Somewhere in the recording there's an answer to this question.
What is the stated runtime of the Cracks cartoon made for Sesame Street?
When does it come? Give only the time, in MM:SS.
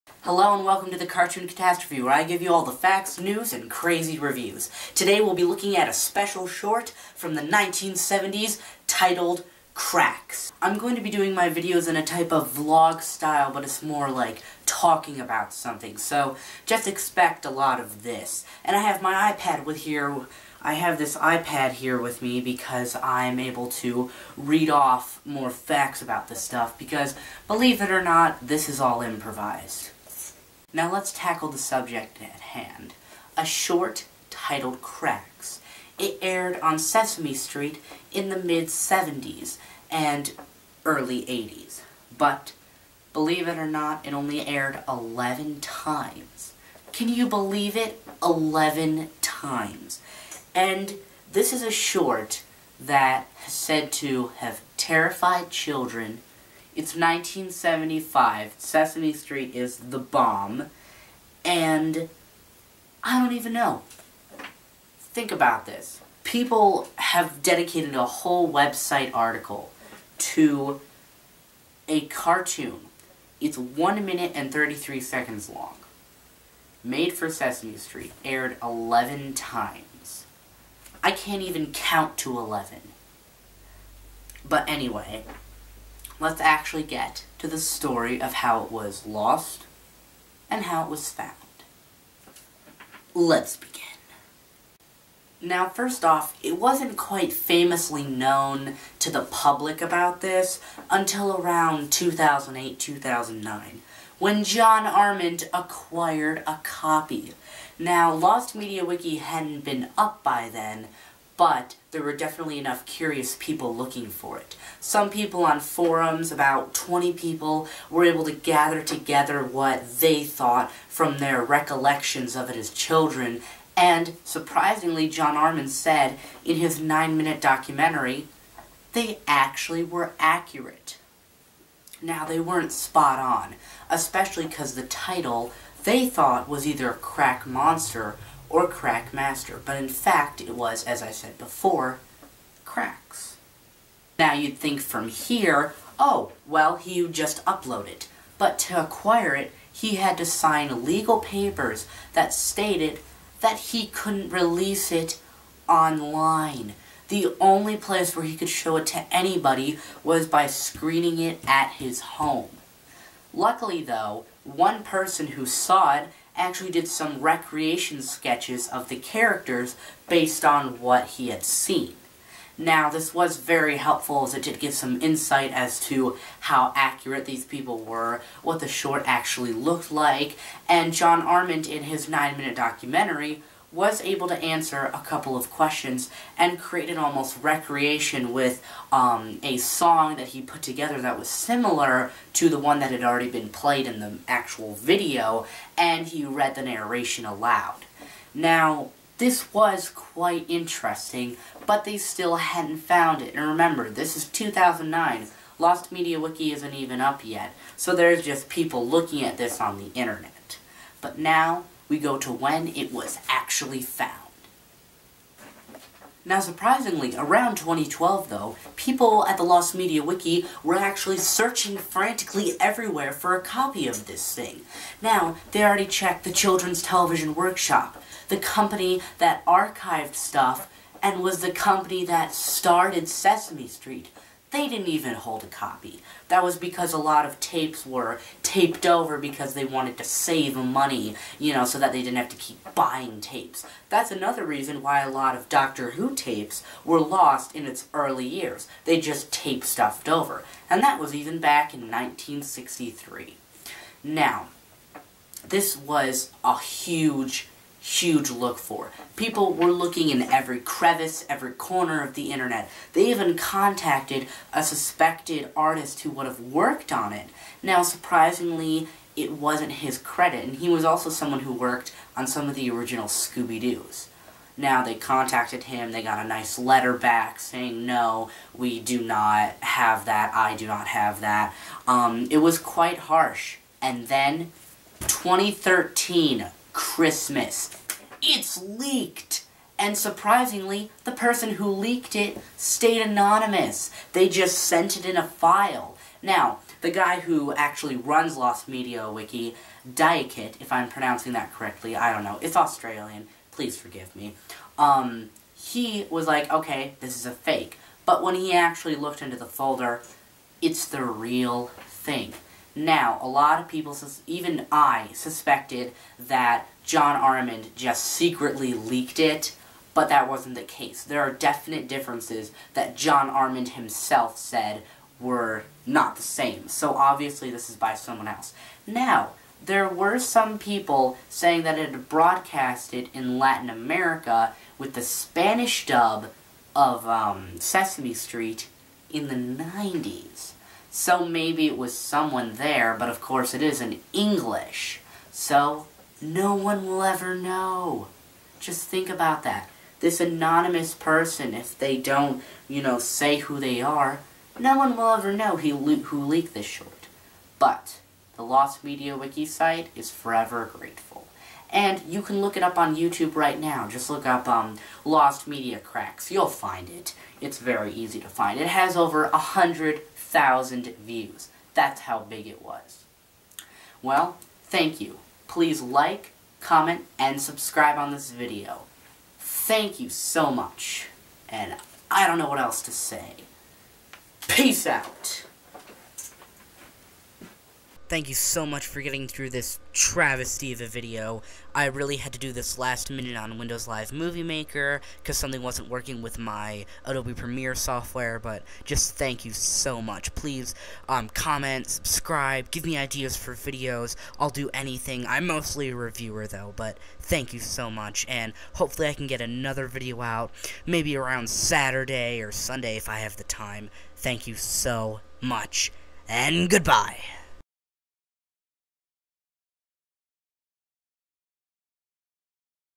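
01:13.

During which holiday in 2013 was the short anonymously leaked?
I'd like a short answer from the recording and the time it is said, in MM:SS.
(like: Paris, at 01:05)
Christmas, at 04:46.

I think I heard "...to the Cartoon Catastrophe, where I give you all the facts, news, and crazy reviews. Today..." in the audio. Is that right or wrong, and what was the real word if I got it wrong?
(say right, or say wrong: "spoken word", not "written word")
right.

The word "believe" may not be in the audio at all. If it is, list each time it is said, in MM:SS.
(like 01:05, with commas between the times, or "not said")
00:27, 00:43, 00:47.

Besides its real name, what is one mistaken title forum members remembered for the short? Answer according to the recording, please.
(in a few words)
Crack Monster.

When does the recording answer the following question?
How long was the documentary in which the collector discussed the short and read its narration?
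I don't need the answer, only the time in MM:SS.
02:06.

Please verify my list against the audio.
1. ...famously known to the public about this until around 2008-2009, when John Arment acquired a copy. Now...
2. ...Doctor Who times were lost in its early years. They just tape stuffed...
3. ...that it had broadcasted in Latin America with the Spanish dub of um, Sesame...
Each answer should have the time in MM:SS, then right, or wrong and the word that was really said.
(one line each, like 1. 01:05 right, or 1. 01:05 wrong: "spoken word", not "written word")
1. 01:37 right
2. 04:05 wrong: "tapes", not "times"
3. 05:31 right.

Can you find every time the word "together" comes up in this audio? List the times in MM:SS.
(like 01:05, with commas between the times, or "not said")
01:58, 03:10.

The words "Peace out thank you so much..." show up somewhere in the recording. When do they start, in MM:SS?
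06:24.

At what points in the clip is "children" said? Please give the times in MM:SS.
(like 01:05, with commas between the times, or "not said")
00:55, 02:02, 03:46.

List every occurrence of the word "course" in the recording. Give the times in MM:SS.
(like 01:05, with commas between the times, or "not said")
05:43.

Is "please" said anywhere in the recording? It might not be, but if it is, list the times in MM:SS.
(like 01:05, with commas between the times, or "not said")
05:03, 06:15, 06:40.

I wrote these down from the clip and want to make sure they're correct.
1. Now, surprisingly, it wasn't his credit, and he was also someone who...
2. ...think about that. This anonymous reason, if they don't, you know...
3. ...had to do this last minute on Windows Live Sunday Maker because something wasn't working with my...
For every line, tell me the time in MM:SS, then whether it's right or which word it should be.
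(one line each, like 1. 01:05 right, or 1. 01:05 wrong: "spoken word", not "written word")
1. 04:27 right
2. 05:48 wrong: "person", not "reason"
3. 06:32 wrong: "Movie", not "Sunday".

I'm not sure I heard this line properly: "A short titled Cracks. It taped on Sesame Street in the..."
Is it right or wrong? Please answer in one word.
wrong.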